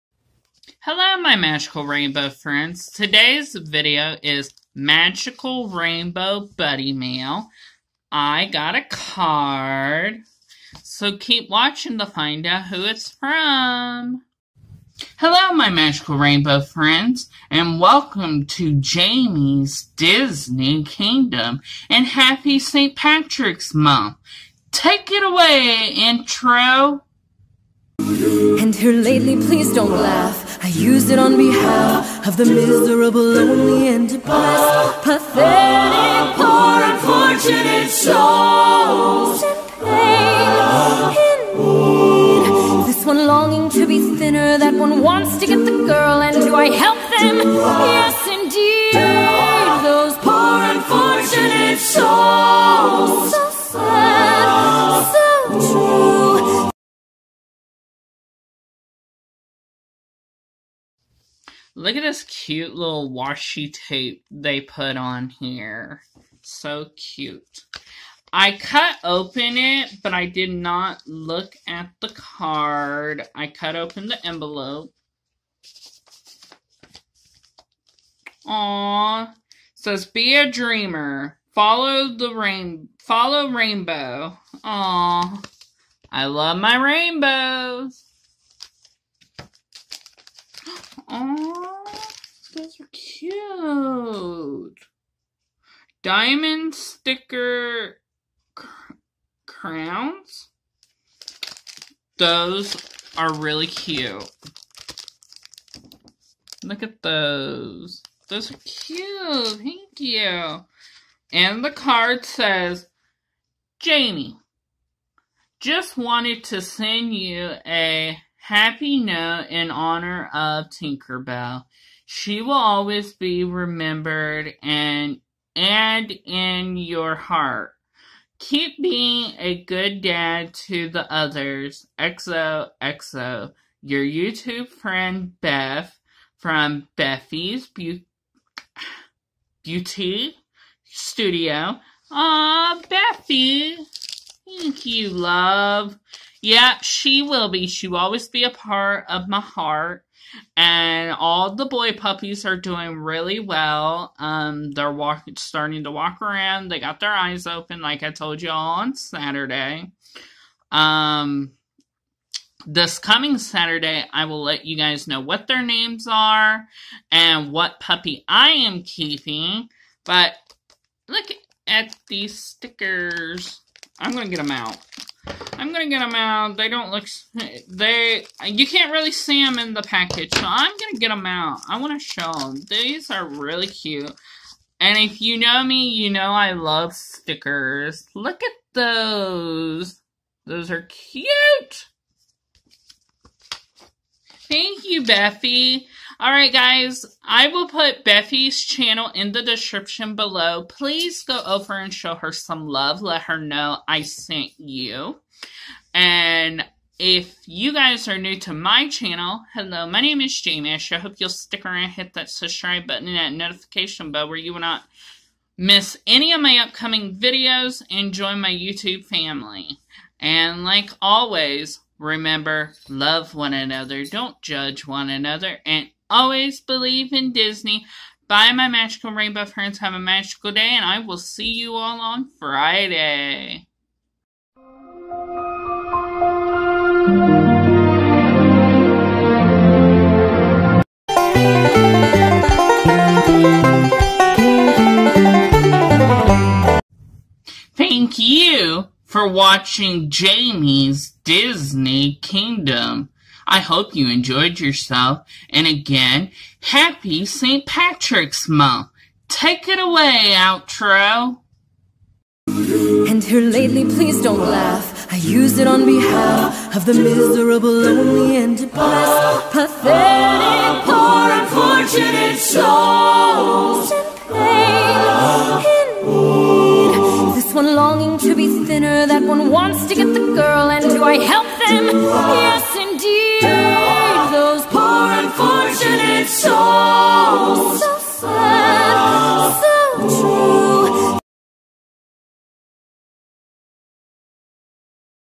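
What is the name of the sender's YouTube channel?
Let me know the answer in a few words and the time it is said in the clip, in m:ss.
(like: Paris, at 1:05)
Bethy's Beauty Studio, at 2:16.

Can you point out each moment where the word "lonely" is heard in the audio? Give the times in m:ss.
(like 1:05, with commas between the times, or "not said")
0:33, 4:27.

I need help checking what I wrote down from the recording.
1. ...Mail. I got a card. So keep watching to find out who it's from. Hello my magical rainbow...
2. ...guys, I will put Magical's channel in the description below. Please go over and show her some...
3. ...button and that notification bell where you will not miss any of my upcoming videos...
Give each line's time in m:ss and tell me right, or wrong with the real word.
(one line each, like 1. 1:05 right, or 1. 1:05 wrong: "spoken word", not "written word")
1. 0:06 right
2. 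3:16 wrong: "Bethy", not "Magical"
3. 3:32 right.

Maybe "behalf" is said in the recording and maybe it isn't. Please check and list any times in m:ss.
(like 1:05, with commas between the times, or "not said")
0:31, 4:25.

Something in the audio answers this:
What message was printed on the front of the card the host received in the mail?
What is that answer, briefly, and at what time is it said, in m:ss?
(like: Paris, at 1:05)
Be a dreamer, at 1:20.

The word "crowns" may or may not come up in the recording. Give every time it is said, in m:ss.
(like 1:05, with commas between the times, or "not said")
1:39.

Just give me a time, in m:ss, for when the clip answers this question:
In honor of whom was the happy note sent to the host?
2:00.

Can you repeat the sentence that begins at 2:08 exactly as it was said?
Keep being a good dad to the others.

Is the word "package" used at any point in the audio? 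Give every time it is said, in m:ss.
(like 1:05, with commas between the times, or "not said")
2:59.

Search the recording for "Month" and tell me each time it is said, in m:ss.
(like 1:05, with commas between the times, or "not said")
0:23, 4:18.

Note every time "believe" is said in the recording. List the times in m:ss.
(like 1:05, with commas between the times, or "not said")
3:46.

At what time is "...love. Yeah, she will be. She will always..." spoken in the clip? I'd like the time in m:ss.
2:25.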